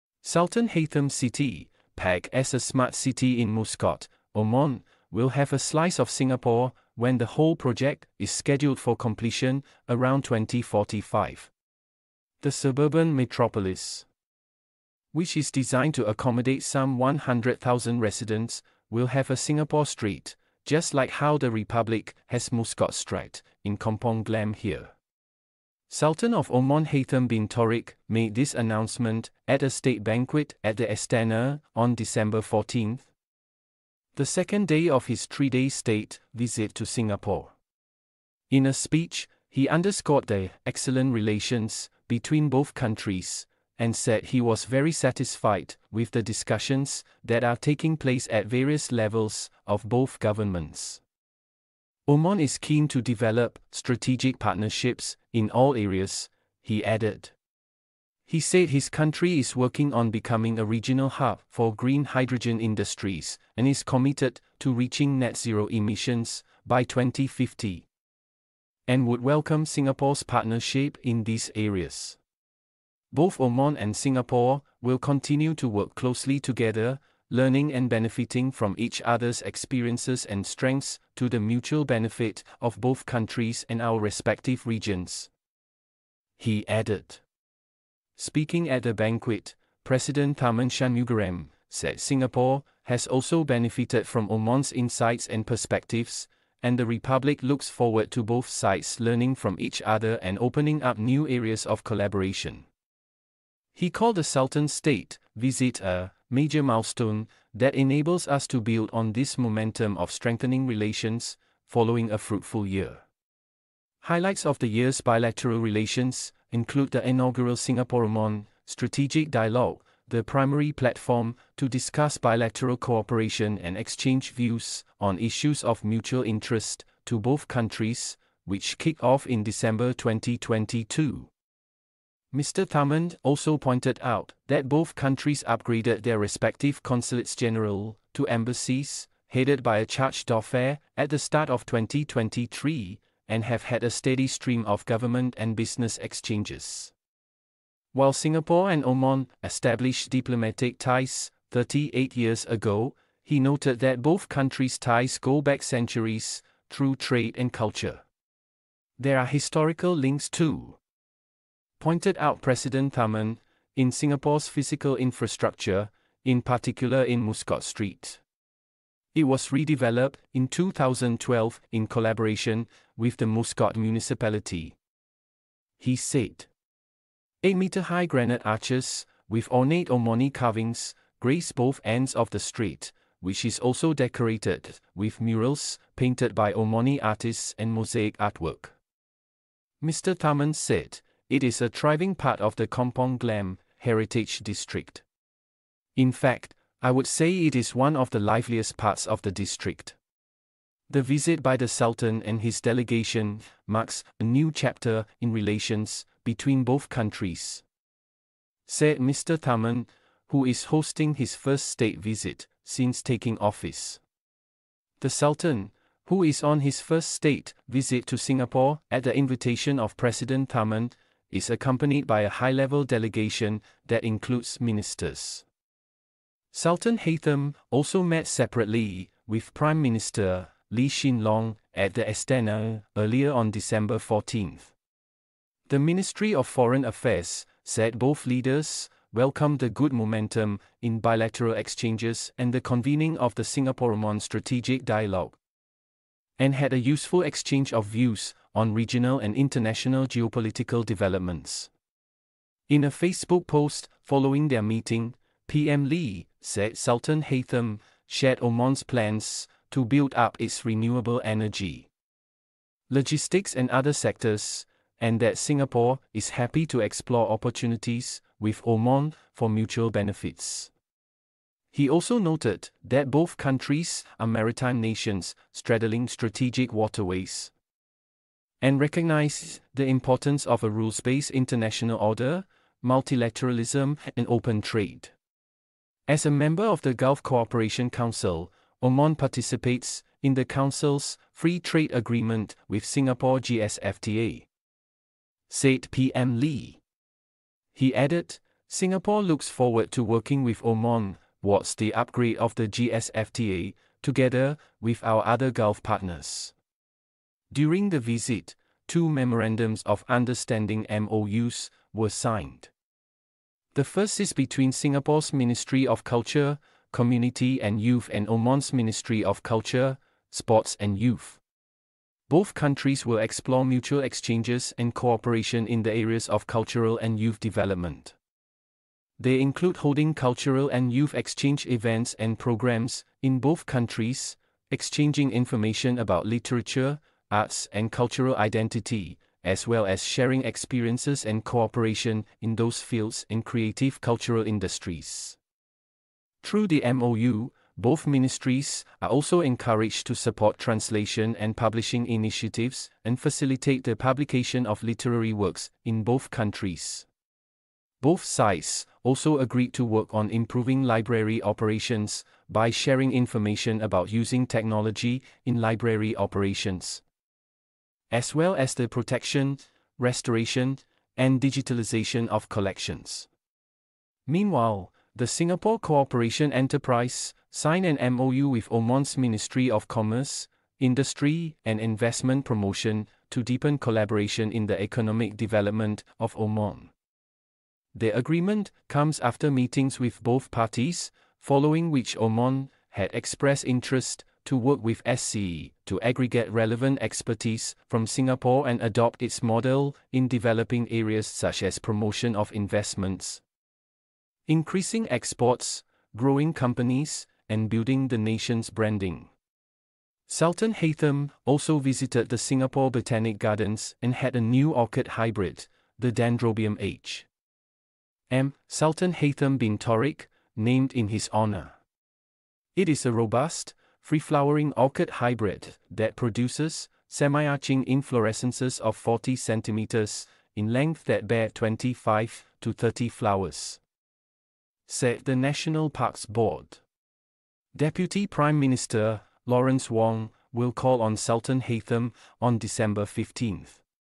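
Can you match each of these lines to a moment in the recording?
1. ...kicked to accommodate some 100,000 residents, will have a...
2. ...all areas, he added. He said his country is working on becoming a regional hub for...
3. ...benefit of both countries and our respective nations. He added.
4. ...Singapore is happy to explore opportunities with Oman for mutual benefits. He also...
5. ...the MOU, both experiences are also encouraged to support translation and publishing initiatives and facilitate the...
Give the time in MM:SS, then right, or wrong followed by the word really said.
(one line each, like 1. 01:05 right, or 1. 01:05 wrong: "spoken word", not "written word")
1. 00:15 wrong: "designed", not "kicked"
2. 00:55 right
3. 01:21 wrong: "regions", not "nations"
4. 04:25 right
5. 05:46 wrong: "ministries", not "experiences".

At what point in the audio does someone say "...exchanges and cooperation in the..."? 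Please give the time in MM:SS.
05:23.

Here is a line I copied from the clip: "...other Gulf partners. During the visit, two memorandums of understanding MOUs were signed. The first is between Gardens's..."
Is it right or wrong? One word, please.
wrong.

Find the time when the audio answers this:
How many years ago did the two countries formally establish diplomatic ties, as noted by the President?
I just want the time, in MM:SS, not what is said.
02:31.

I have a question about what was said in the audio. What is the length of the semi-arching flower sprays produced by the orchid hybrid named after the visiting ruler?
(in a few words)
40 centimeters.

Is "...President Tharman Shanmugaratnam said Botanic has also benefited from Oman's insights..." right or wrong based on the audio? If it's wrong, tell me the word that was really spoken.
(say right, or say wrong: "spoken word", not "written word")
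wrong: "Singapore", not "Botanic".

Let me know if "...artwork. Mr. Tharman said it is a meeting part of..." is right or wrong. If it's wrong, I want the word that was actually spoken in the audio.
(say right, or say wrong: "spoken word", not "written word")
wrong: "thriving", not "meeting".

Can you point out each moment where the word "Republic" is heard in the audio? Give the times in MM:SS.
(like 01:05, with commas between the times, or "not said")
00:21, 01:36.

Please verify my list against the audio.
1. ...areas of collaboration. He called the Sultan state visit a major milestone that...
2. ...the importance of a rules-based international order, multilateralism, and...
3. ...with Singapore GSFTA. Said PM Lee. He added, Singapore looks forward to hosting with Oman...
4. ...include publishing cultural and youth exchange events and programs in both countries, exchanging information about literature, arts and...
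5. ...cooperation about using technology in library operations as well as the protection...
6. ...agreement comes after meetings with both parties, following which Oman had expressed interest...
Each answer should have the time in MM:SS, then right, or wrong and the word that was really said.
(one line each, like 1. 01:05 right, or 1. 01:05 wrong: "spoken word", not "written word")
1. 01:41 right
2. 04:39 right
3. 04:52 wrong: "working", not "hosting"
4. 05:29 wrong: "holding", not "publishing"
5. 06:03 wrong: "information", not "cooperation"
6. 06:28 right.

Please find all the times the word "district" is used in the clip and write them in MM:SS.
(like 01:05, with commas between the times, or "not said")
03:14, 03:19.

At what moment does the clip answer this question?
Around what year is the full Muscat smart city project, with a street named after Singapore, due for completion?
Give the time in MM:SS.
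00:10.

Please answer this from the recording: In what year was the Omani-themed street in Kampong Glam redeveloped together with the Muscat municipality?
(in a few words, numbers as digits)
2012.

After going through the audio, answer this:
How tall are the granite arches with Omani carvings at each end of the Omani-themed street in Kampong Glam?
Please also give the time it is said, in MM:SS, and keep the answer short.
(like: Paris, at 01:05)
8 meters, at 02:57.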